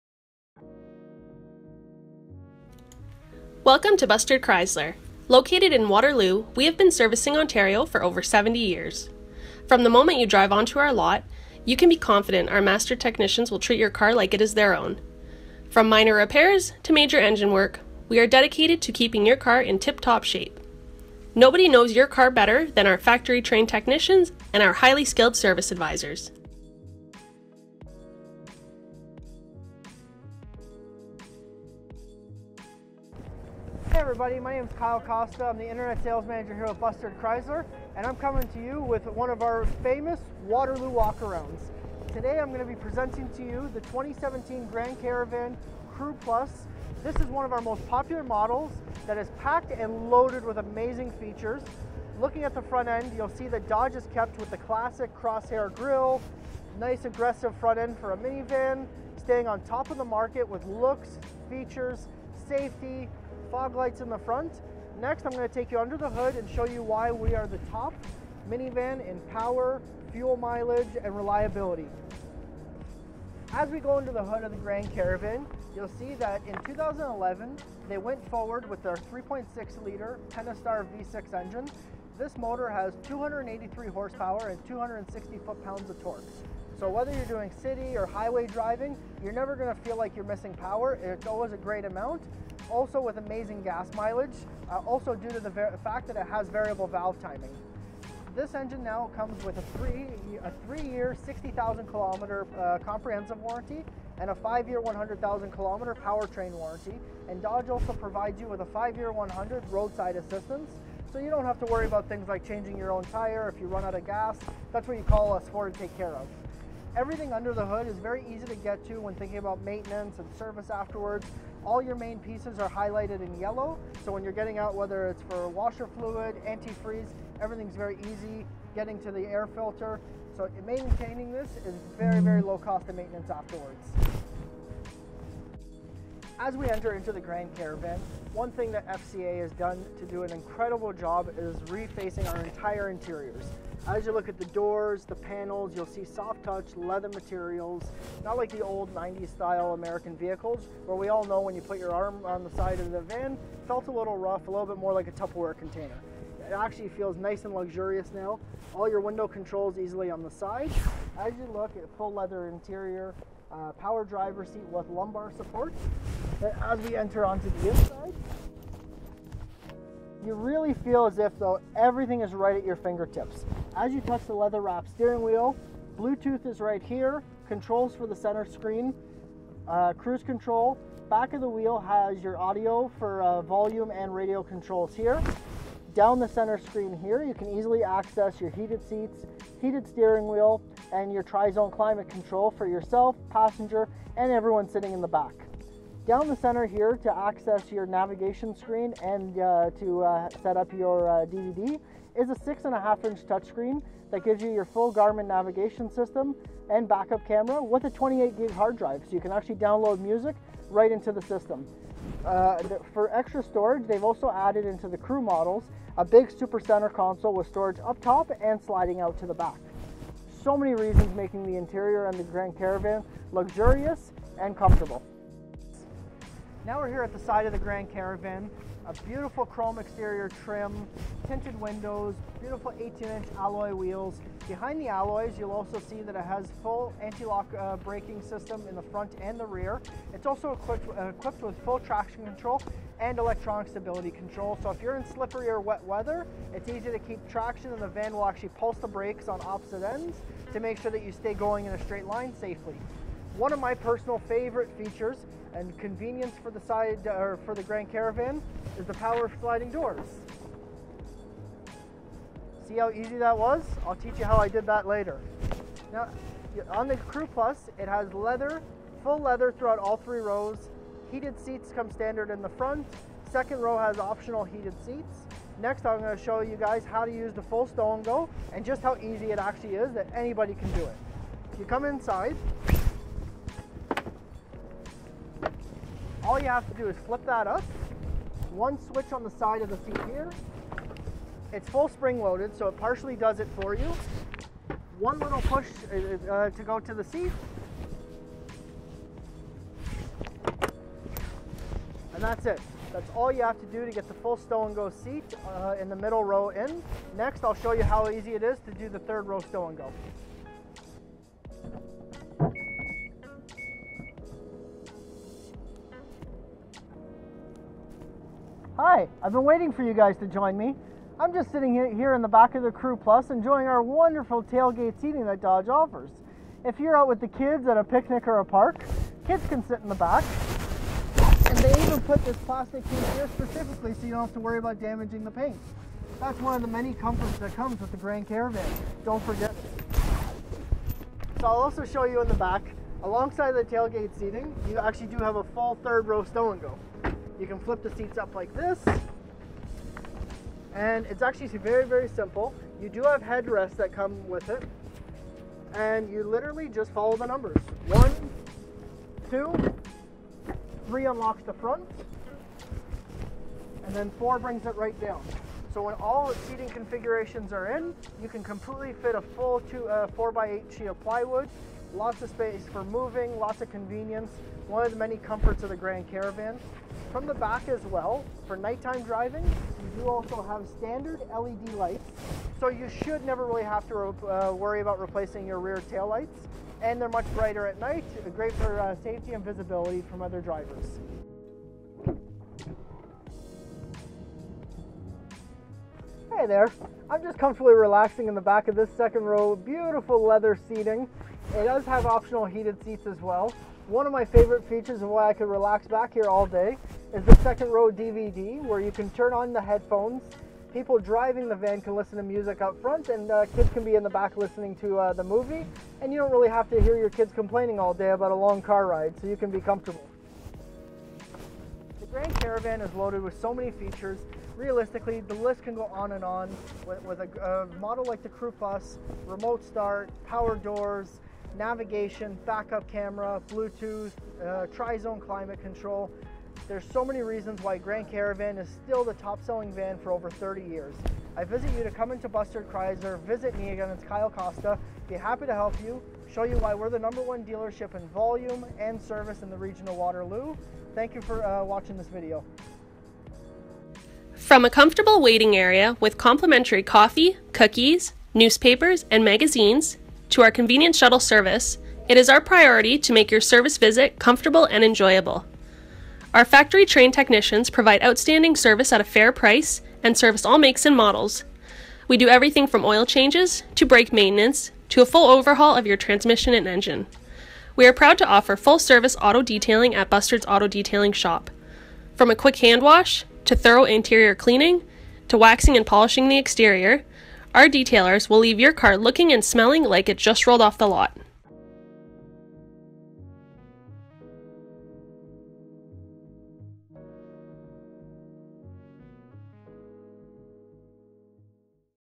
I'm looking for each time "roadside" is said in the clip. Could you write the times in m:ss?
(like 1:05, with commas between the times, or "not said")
1:49.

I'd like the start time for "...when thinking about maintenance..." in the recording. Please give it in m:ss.
1:58.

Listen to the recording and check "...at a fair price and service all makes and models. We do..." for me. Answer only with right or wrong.
right.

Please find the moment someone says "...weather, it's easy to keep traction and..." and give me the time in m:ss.
4:05.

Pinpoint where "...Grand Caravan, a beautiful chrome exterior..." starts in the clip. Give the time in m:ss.
3:47.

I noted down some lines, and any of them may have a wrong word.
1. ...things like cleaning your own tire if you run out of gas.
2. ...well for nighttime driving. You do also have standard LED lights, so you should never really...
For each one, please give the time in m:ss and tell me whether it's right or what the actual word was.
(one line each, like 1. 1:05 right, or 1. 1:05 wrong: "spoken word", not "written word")
1. 1:52 wrong: "changing", not "cleaning"
2. 6:17 right.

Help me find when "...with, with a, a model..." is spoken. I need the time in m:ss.
7:06.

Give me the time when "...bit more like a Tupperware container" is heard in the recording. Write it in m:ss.
2:34.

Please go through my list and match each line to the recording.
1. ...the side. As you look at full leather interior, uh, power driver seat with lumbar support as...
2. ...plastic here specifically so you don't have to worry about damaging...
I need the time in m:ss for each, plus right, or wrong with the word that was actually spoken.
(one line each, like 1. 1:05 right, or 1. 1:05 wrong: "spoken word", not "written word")
1. 2:40 right
2. 5:32 right.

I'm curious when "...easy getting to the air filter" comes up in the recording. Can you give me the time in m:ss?
2:08.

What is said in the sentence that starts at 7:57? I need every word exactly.
We are proud to offer full service auto detailing at Bustard's Auto Detailing Shop.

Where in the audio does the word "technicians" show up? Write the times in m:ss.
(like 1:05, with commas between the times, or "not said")
0:12, 0:23, 7:47.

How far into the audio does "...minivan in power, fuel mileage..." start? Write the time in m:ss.
1:08.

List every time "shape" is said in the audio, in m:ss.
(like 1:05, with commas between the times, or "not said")
0:20.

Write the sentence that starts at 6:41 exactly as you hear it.
It does have optional heated seats as well.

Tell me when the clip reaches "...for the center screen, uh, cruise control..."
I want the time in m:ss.
2:57.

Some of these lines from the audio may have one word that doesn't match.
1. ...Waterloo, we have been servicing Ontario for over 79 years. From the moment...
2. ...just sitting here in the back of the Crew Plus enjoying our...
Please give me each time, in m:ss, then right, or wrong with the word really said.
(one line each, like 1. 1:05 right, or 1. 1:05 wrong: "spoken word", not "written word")
1. 0:05 wrong: "70", not "79"
2. 5:21 right.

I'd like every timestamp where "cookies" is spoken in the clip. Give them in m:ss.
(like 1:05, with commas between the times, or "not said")
7:37.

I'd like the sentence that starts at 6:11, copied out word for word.
Lots of space for moving, lots of convenience.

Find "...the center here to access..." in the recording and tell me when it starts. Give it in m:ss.
3:16.